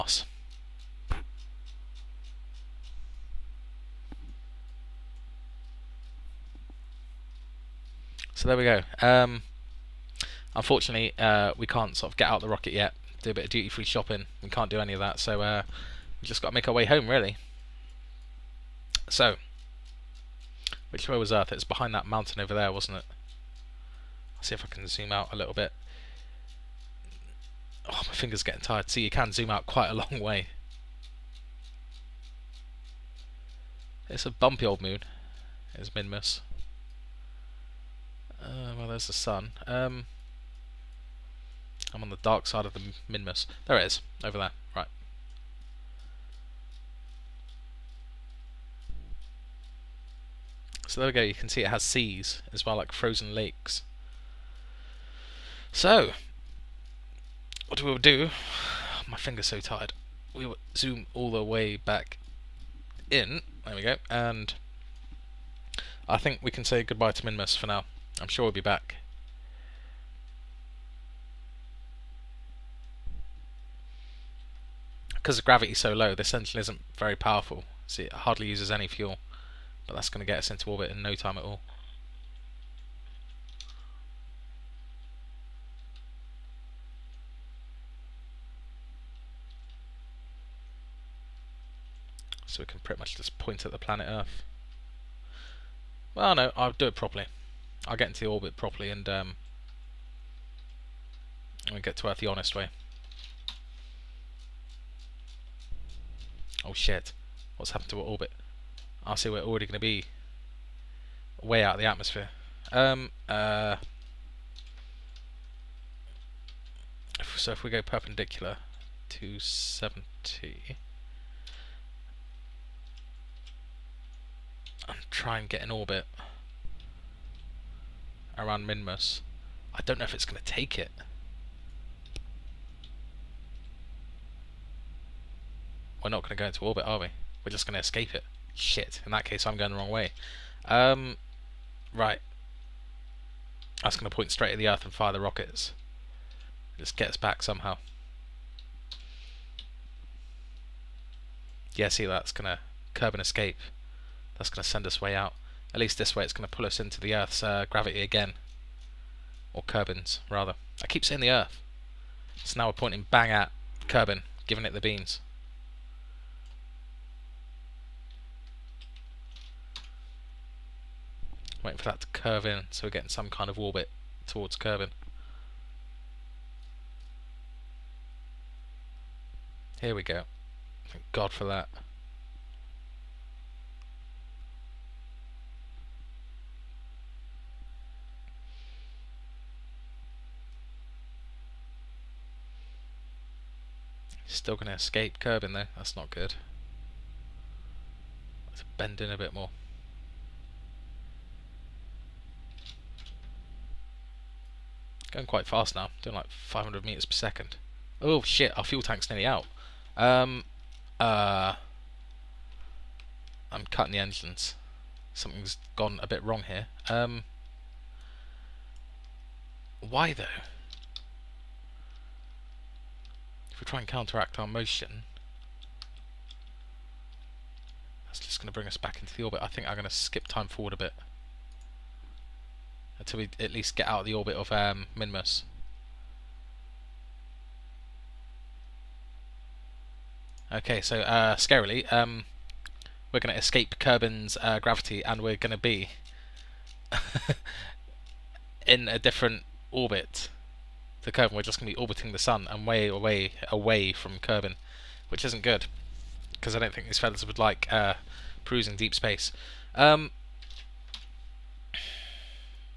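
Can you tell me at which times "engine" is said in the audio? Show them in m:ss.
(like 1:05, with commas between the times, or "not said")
1:16, 3:33.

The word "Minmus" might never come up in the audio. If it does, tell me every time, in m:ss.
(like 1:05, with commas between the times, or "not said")
0:35, 0:43, 1:07, 2:08, 3:54.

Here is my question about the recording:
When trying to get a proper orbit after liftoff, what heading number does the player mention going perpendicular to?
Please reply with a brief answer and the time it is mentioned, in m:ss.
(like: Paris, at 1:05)
70, at 1:59.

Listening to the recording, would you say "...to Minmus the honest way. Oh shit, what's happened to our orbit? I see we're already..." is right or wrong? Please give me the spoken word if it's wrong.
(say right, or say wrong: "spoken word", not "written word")
wrong: "Earth", not "Minmus".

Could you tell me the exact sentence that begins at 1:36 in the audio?
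Well, no, I'll do it properly.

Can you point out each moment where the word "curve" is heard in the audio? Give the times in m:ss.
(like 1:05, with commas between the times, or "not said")
2:52.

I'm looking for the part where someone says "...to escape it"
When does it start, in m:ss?
2:17.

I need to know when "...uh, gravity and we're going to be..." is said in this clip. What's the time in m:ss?
4:04.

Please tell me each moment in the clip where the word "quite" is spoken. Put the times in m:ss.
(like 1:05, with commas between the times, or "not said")
0:29, 3:25.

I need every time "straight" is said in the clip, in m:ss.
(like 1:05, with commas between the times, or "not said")
2:24.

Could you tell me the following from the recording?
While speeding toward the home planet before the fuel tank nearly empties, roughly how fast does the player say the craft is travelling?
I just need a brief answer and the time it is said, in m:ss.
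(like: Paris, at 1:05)
500 meters per second, at 3:26.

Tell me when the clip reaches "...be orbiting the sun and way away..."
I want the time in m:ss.
4:11.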